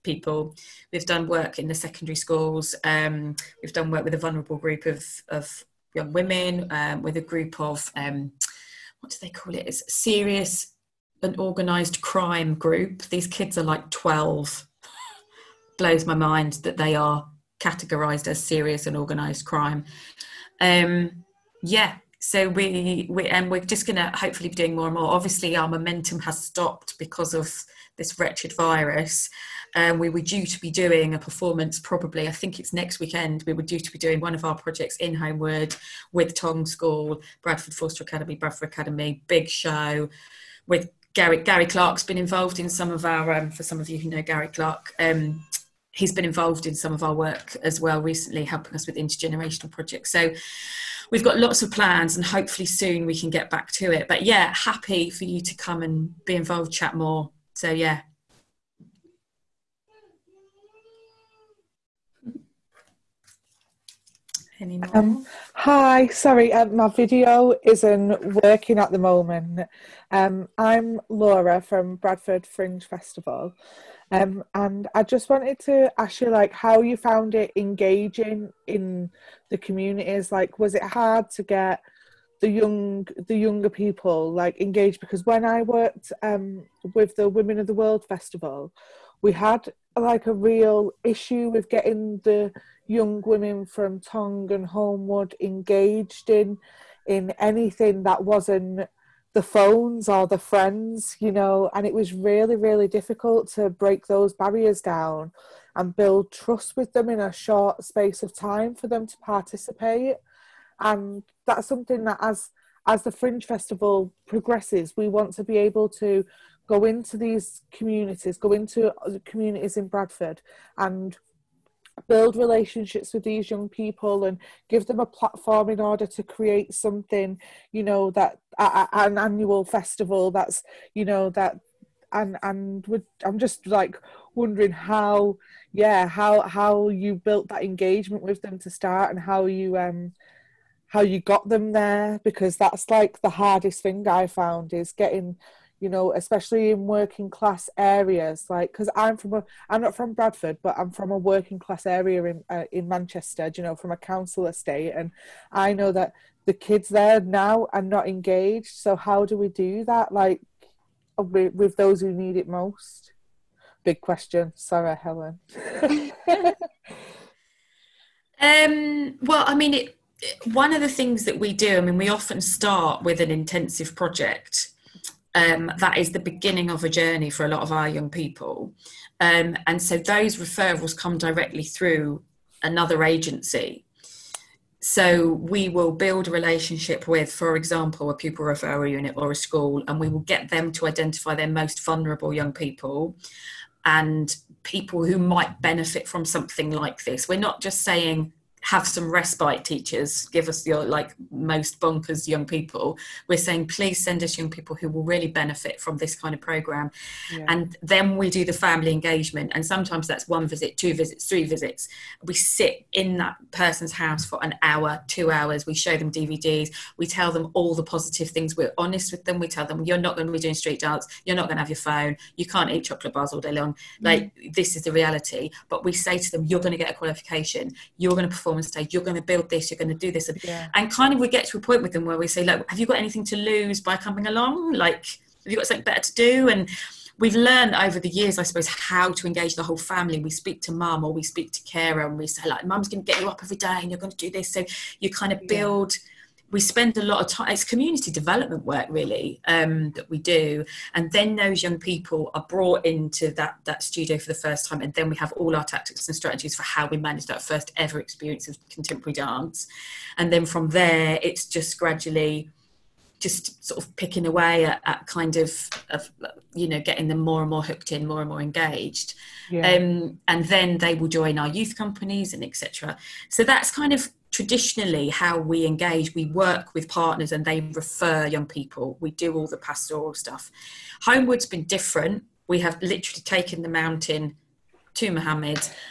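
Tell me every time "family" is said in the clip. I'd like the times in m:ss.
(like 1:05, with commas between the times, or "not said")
3:28, 3:59.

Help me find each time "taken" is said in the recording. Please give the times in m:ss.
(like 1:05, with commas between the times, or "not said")
4:43.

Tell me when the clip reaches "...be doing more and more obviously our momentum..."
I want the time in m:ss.
0:24.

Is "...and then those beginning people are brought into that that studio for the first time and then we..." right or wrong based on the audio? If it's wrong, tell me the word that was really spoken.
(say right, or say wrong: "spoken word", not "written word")
wrong: "young", not "beginning".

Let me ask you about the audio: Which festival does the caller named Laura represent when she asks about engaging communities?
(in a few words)
Bradford Fringe Festival.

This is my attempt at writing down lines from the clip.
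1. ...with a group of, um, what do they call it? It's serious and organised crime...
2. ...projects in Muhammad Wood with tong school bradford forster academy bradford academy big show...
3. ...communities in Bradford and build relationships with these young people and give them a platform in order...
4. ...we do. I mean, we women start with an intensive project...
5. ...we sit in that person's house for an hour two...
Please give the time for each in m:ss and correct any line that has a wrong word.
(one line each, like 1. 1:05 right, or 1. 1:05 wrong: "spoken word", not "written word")
1. 0:07 right
2. 0:34 wrong: "Holme", not "Muhammad"
3. 1:59 right
4. 2:51 wrong: "often", not "women"
5. 3:32 right.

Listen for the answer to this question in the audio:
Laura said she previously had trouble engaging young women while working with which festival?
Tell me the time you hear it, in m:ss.
1:27.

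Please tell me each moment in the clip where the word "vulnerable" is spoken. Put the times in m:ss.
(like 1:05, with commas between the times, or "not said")
0:04, 3:11.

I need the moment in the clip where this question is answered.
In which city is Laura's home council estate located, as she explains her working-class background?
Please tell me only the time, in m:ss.
2:32.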